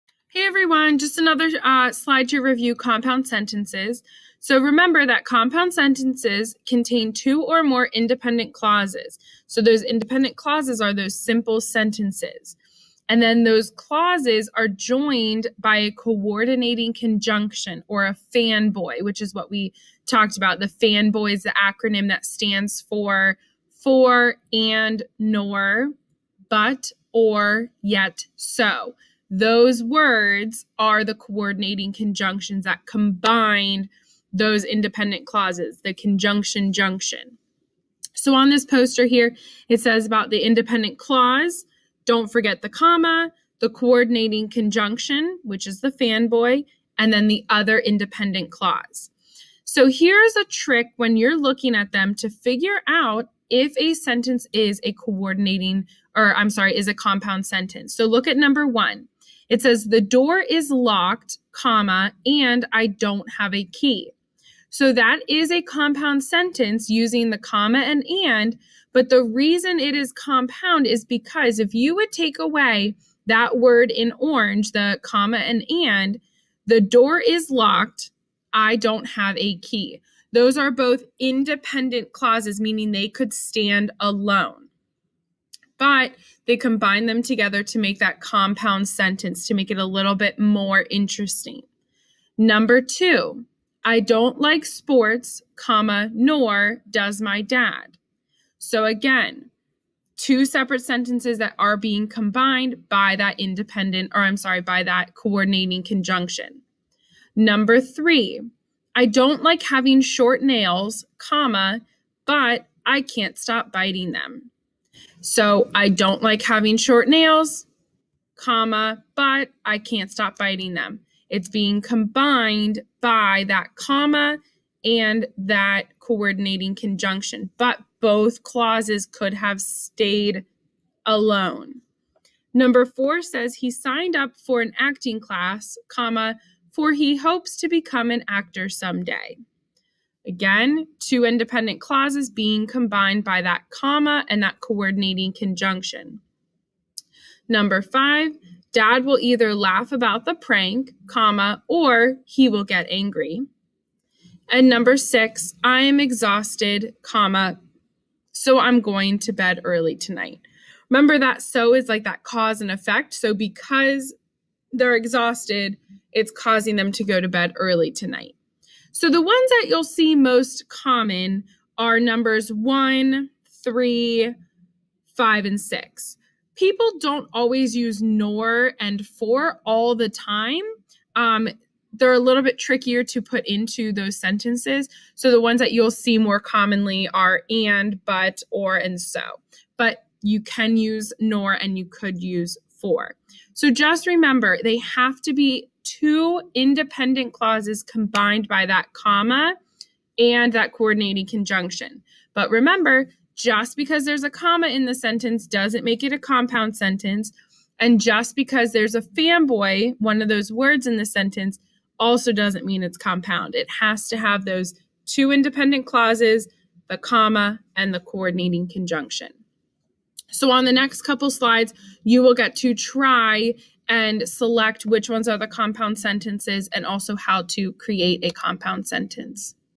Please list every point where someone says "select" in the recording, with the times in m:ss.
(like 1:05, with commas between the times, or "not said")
3:44.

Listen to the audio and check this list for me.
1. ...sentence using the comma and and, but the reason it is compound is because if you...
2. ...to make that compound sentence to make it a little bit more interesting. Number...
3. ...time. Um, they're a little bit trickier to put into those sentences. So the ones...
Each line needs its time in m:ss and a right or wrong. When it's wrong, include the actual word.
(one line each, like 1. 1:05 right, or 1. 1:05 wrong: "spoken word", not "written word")
1. 1:06 right
2. 1:27 right
3. 3:00 right.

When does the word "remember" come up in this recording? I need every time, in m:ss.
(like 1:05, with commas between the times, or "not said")
0:04, 2:40, 3:14, 3:22.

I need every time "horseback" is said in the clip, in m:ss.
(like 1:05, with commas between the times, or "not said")
not said.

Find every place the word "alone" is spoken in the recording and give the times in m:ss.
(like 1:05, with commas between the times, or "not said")
1:23, 2:11.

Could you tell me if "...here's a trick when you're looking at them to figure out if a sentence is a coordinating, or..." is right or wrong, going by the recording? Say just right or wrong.
right.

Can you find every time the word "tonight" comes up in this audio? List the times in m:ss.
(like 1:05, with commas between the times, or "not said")
2:39, 2:47.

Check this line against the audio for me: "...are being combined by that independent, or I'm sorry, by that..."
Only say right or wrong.
right.